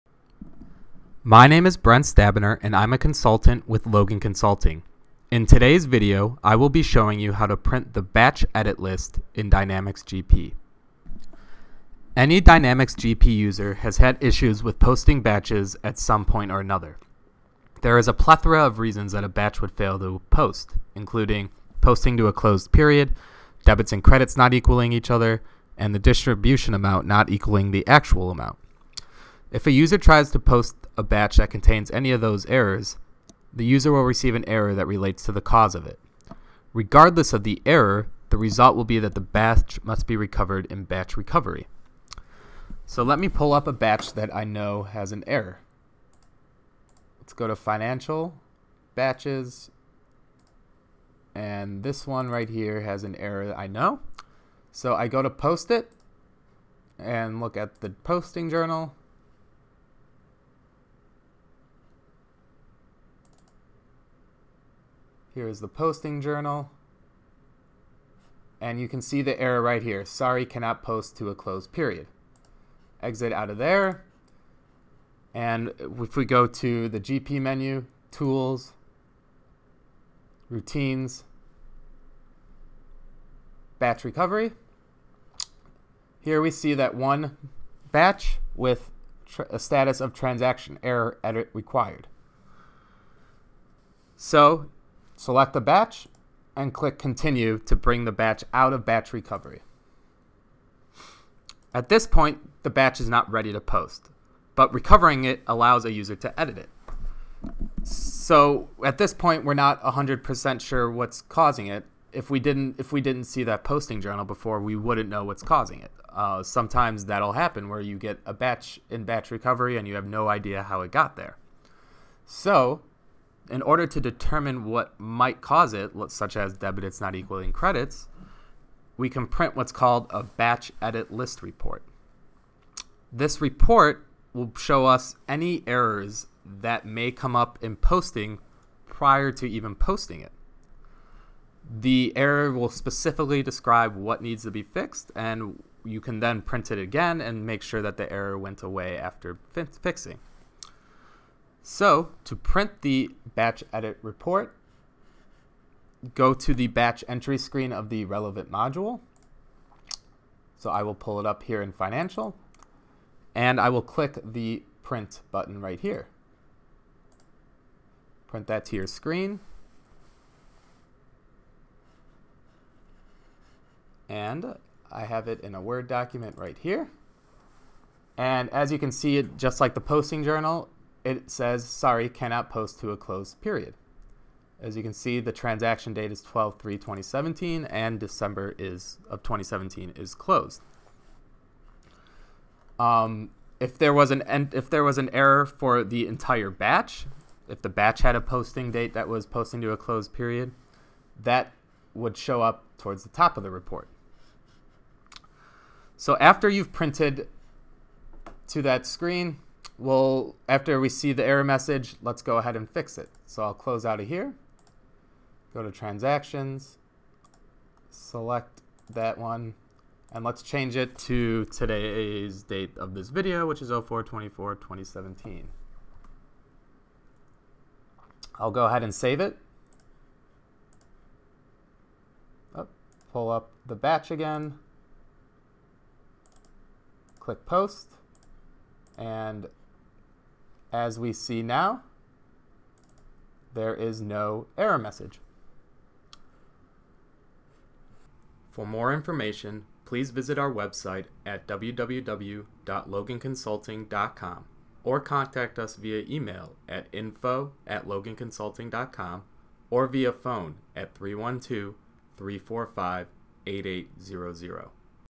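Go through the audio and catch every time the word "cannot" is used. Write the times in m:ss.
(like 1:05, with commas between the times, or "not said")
1:10, 3:02.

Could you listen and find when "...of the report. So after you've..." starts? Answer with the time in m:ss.
3:23.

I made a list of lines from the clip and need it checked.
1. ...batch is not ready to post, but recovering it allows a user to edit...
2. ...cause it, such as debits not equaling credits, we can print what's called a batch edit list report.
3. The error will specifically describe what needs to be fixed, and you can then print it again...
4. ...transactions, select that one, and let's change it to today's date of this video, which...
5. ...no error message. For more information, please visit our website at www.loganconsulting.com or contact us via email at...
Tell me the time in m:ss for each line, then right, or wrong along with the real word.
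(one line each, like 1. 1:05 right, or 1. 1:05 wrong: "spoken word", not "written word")
1. 1:42 right
2. 2:05 right
3. 2:21 right
4. 3:35 right
5. 4:04 right.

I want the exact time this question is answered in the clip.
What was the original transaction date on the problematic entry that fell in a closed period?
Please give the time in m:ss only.
3:06.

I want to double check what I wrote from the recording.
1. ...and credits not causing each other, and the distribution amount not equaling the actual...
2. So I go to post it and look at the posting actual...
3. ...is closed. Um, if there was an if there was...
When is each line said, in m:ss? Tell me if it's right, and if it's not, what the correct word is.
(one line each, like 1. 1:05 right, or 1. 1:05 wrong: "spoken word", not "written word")
1. 0:23 wrong: "equaling", not "causing"
2. 0:54 wrong: "journal", not "actual"
3. 3:09 right.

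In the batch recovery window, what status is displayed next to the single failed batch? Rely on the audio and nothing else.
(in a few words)
transaction error edit required.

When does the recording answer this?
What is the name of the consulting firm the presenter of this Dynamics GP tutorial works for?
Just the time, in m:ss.
0:03.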